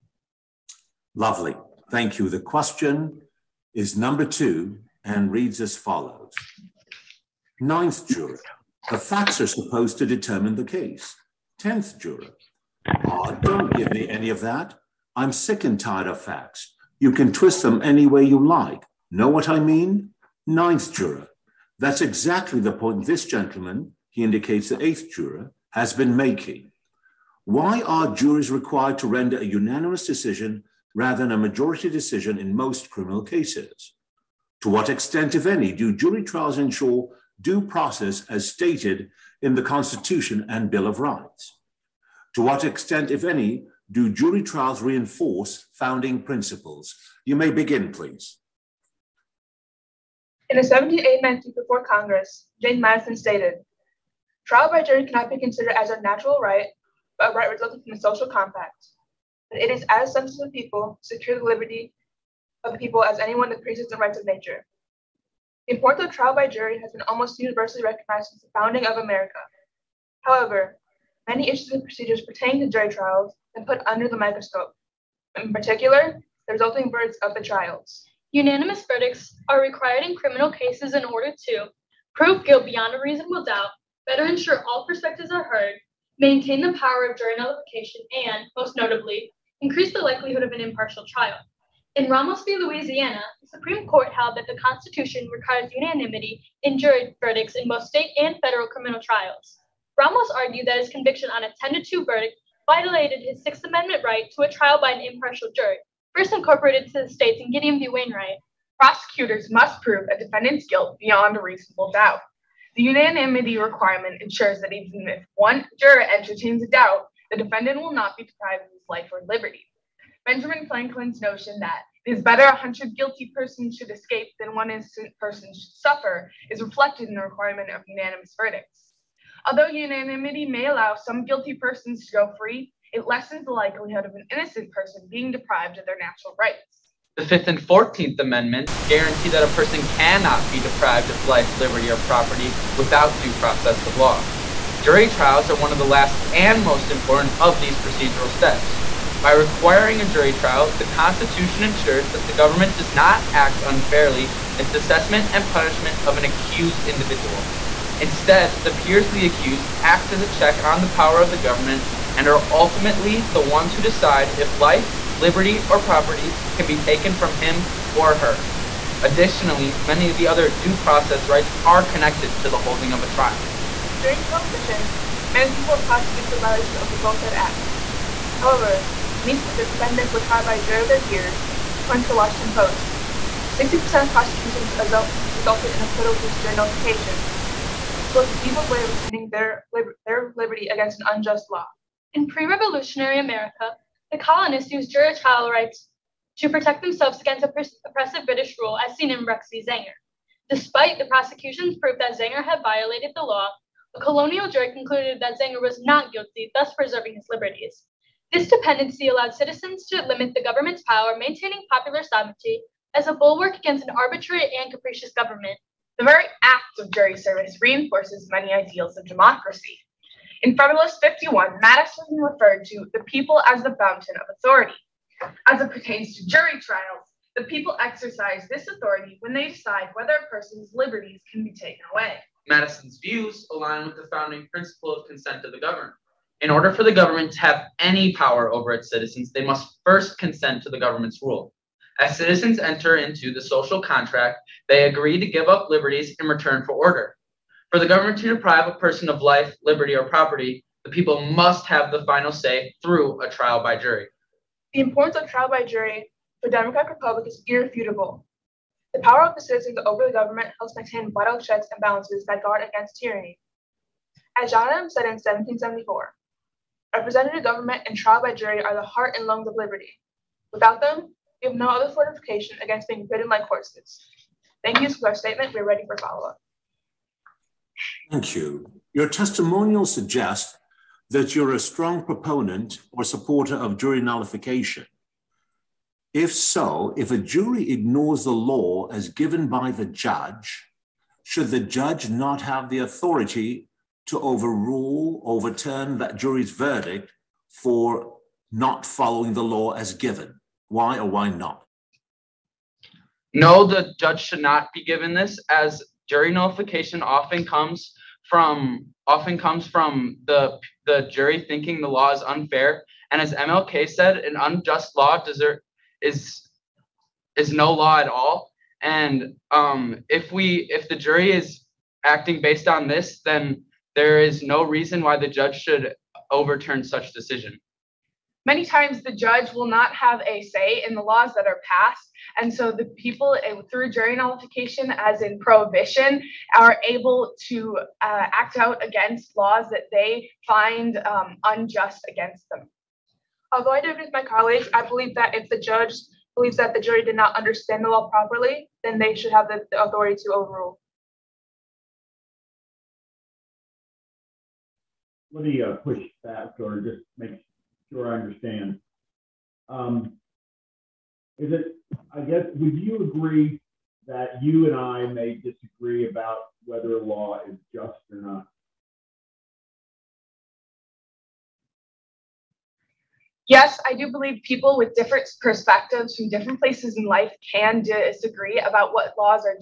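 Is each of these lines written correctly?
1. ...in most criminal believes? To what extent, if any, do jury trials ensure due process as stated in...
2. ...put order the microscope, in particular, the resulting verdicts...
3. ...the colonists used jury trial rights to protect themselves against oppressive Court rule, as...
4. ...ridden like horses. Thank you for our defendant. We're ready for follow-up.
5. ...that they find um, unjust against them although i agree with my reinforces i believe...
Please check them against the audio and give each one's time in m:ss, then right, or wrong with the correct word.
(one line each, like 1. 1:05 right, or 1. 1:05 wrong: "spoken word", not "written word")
1. 0:32 wrong: "cases", not "believes"
2. 1:13 wrong: "under", not "order"
3. 3:14 wrong: "British", not "Court"
4. 4:33 wrong: "statement", not "defendant"
5. 5:39 wrong: "colleagues", not "reinforces".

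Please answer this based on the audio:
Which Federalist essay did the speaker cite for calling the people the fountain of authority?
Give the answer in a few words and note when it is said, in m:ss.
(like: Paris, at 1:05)
Federalist 51, at 3:40.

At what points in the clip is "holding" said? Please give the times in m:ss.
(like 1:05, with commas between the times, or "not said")
2:52.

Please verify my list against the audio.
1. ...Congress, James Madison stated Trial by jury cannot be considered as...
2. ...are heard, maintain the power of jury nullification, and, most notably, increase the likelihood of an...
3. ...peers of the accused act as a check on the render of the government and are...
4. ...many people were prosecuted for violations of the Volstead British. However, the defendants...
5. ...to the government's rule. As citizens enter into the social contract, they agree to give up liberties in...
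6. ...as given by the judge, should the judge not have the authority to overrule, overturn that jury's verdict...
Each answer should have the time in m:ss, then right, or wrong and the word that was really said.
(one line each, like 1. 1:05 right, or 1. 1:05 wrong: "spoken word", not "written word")
1. 0:51 right
2. 1:25 right
3. 2:38 wrong: "power", not "render"
4. 2:55 wrong: "Act", not "British"
5. 4:00 right
6. 4:48 right.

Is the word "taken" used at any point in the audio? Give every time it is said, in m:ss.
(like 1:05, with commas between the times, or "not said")
2:46, 3:51.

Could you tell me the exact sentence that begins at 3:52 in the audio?
Madison's views align with the founding principle of consent of the governed.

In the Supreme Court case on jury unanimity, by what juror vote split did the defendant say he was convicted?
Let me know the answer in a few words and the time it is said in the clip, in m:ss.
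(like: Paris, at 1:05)
10 to 2, at 1:41.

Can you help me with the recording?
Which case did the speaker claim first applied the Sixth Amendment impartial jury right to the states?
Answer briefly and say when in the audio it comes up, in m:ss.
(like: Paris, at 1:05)
Gideon v. Wainwright, at 1:47.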